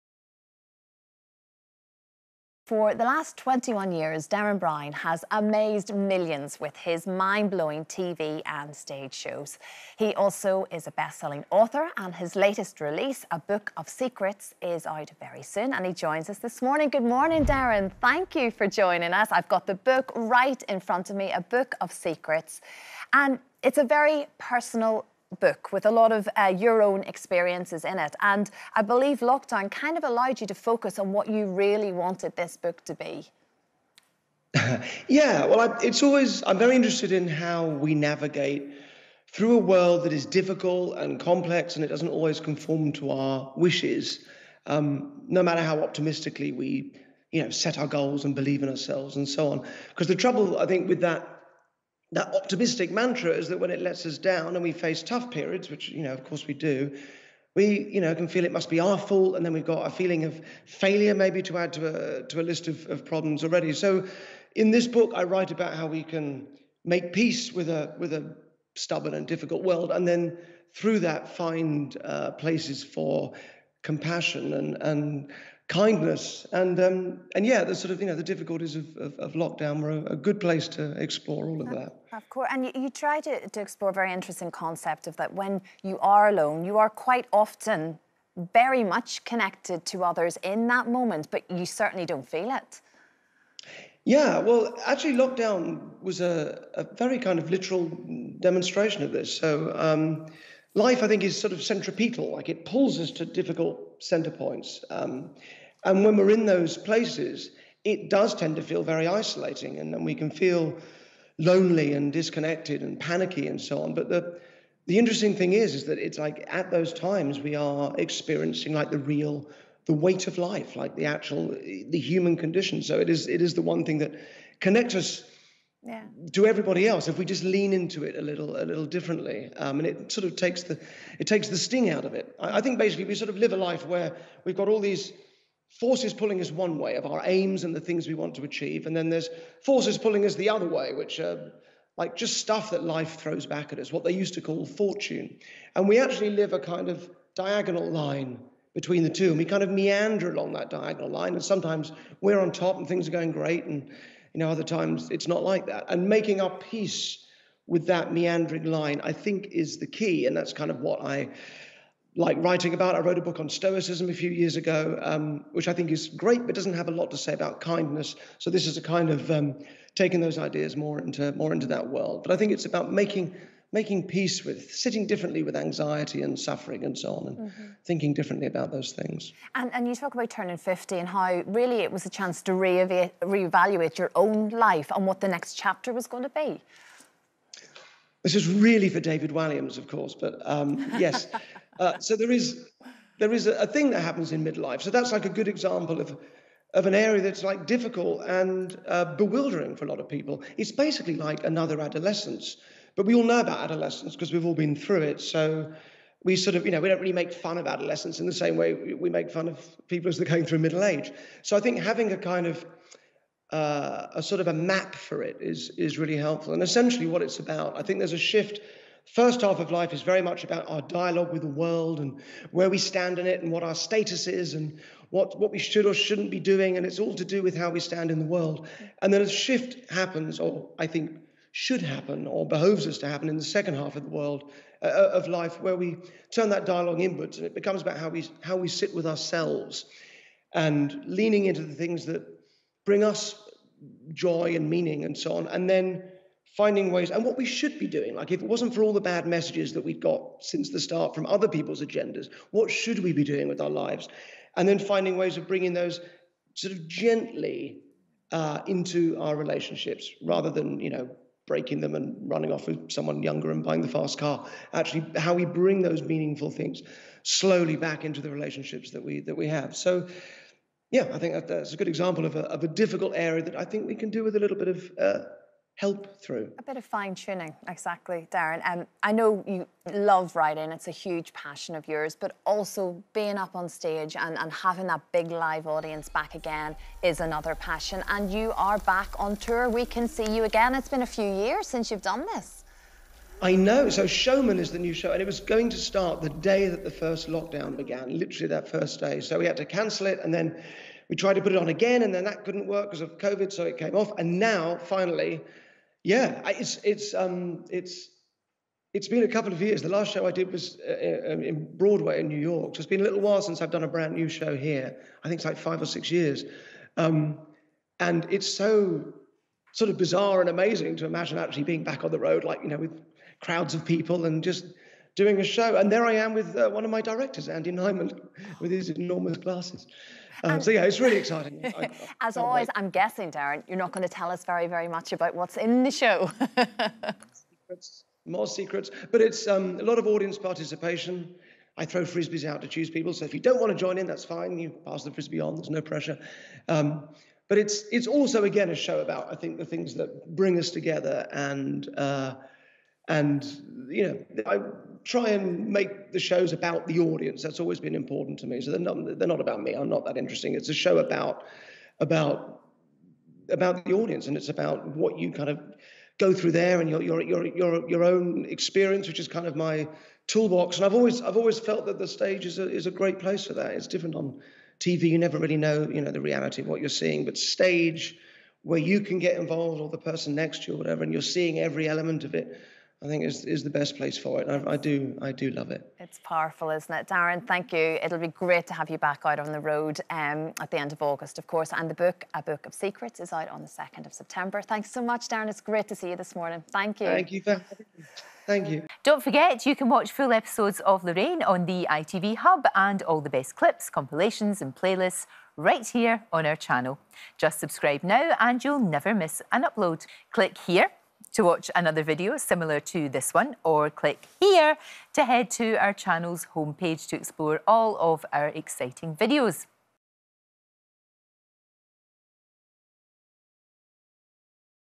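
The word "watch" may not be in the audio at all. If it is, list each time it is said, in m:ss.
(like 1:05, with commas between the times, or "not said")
6:39, 6:51.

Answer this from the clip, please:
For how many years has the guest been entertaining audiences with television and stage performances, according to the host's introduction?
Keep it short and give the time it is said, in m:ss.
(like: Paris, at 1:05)
21, at 0:03.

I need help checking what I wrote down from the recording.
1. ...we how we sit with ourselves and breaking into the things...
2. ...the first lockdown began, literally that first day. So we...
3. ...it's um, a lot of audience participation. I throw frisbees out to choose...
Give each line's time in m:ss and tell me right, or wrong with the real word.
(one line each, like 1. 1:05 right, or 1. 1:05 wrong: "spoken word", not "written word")
1. 3:58 wrong: "leaning", not "breaking"
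2. 4:56 right
3. 5:39 right.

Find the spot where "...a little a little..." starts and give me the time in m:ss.
2:08.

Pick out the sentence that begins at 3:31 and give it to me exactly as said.
So I think having a kind of uh, a sort of a map for it is is really helpful.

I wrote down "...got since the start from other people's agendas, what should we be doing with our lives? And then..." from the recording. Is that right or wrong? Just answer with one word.
right.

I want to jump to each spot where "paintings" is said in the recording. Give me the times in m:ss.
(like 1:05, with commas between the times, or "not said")
not said.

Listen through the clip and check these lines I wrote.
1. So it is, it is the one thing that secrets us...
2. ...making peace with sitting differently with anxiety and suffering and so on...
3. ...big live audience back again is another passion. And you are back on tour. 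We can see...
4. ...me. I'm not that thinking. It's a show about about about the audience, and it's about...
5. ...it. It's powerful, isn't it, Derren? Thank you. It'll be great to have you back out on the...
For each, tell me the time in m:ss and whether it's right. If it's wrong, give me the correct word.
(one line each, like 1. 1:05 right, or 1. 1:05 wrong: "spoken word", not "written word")
1. 2:02 wrong: "connects", not "secrets"
2. 2:53 right
3. 4:45 right
4. 5:59 wrong: "interesting", not "thinking"
5. 6:25 right.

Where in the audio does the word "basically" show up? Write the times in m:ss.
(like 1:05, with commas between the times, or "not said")
2:12, 3:20.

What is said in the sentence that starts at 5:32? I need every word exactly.
I'm guessing, Derren, you're not going to tell us very, very much about what's in the show.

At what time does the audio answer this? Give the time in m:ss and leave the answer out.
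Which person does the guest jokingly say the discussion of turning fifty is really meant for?
3:08.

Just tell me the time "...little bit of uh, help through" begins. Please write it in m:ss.
4:34.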